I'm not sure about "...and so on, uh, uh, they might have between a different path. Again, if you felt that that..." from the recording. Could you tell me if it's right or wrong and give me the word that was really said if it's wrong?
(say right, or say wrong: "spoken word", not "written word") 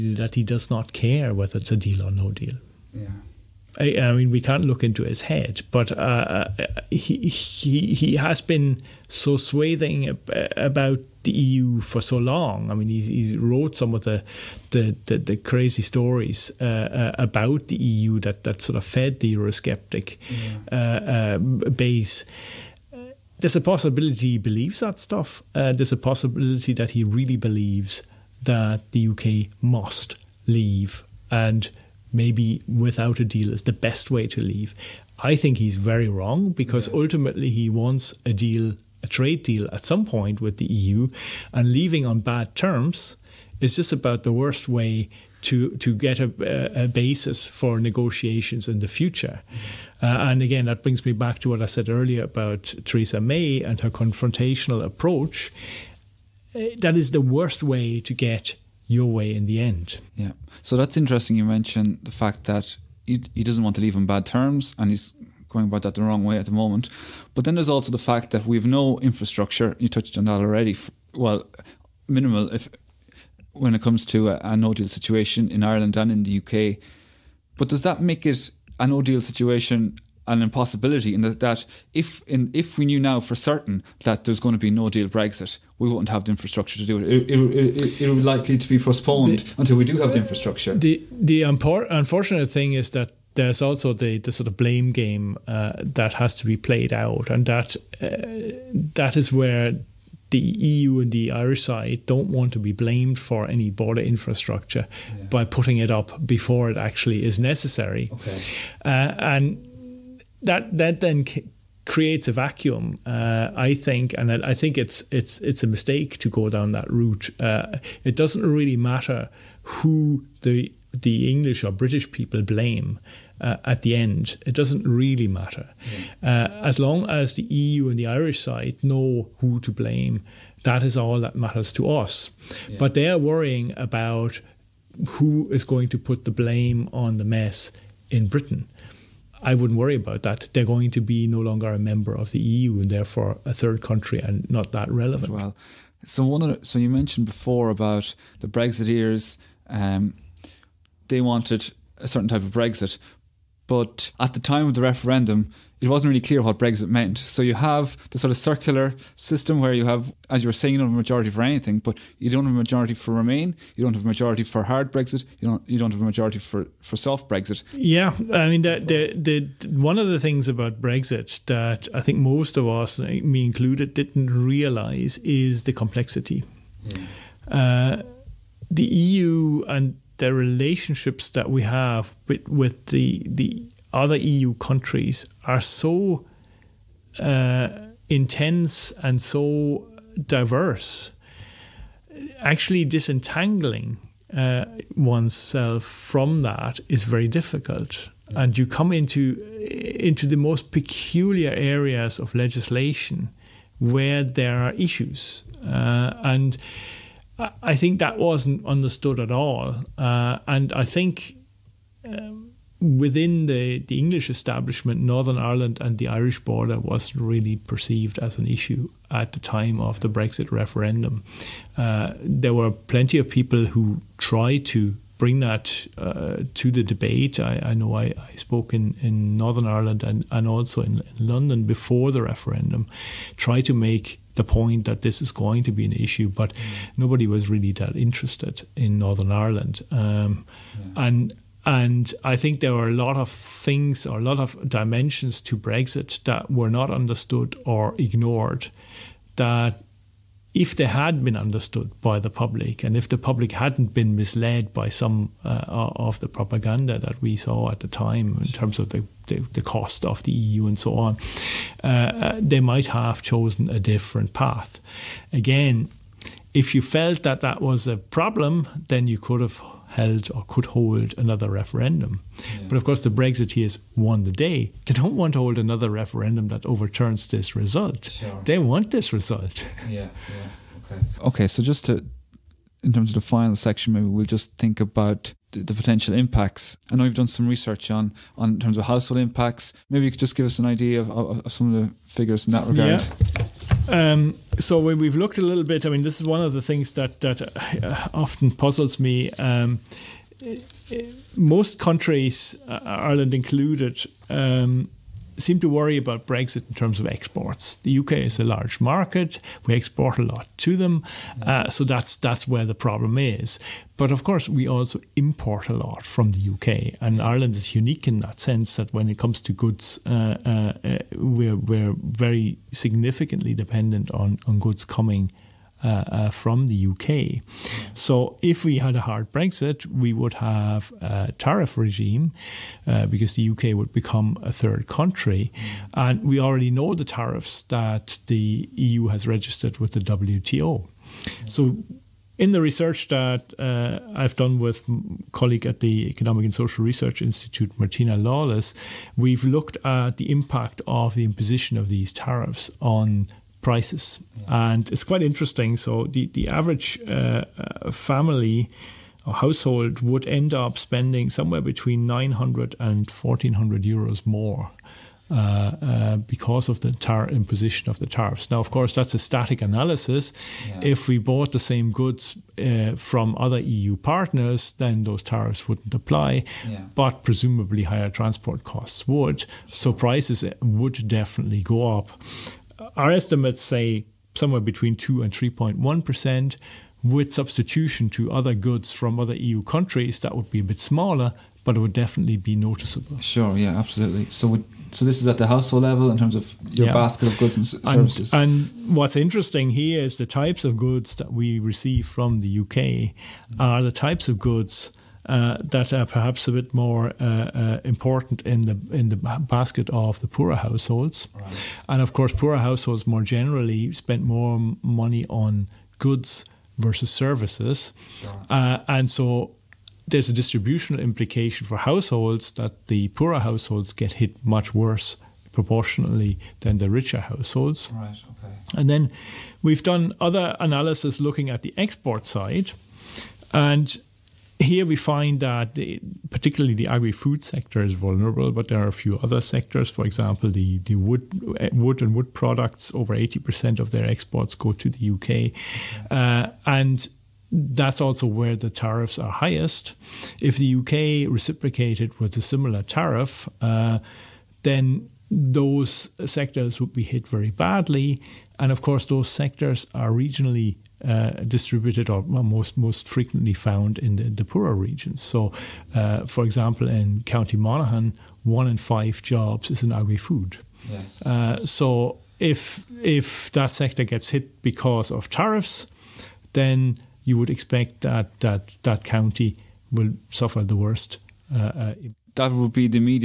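wrong: "chosen", not "between".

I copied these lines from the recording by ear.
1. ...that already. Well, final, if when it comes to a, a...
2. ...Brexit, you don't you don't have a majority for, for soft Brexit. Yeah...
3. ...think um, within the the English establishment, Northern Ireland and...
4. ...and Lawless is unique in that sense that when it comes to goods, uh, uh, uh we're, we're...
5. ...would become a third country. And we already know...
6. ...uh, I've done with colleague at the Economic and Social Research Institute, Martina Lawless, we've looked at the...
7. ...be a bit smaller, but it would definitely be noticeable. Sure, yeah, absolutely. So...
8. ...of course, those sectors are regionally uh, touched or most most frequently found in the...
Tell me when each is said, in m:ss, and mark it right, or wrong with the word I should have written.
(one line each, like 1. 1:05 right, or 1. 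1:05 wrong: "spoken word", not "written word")
1. 1:10 wrong: "minimal", not "final"
2. 2:44 right
3. 3:30 right
4. 5:17 wrong: "Ireland", not "Lawless"
5. 5:33 right
6. 5:43 right
7. 6:30 right
8. 7:38 wrong: "distributed", not "touched".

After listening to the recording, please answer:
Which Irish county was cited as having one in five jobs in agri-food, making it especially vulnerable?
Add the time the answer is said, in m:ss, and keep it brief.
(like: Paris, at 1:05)
Monaghan, at 7:47.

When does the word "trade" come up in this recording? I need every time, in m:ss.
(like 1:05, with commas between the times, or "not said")
0:39.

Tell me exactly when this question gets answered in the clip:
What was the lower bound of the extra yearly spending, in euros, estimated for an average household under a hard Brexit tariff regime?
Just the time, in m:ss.
6:02.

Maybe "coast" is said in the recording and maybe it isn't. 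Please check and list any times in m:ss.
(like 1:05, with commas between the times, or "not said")
not said.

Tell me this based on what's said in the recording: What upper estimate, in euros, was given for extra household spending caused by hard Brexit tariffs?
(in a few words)
1400.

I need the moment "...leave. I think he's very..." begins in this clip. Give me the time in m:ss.
0:34.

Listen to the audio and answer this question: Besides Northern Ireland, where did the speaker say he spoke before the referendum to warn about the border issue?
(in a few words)
London.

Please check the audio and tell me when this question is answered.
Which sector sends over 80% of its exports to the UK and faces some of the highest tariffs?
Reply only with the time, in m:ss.
7:21.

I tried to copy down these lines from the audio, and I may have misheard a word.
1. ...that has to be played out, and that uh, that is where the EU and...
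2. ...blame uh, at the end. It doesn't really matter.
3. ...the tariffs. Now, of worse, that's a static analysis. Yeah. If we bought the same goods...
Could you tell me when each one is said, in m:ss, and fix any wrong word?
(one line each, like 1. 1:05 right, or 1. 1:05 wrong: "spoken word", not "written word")
1. 1:35 right
2. 2:02 right
3. 6:07 wrong: "course", not "worse".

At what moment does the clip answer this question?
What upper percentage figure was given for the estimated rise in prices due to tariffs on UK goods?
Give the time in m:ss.
6:25.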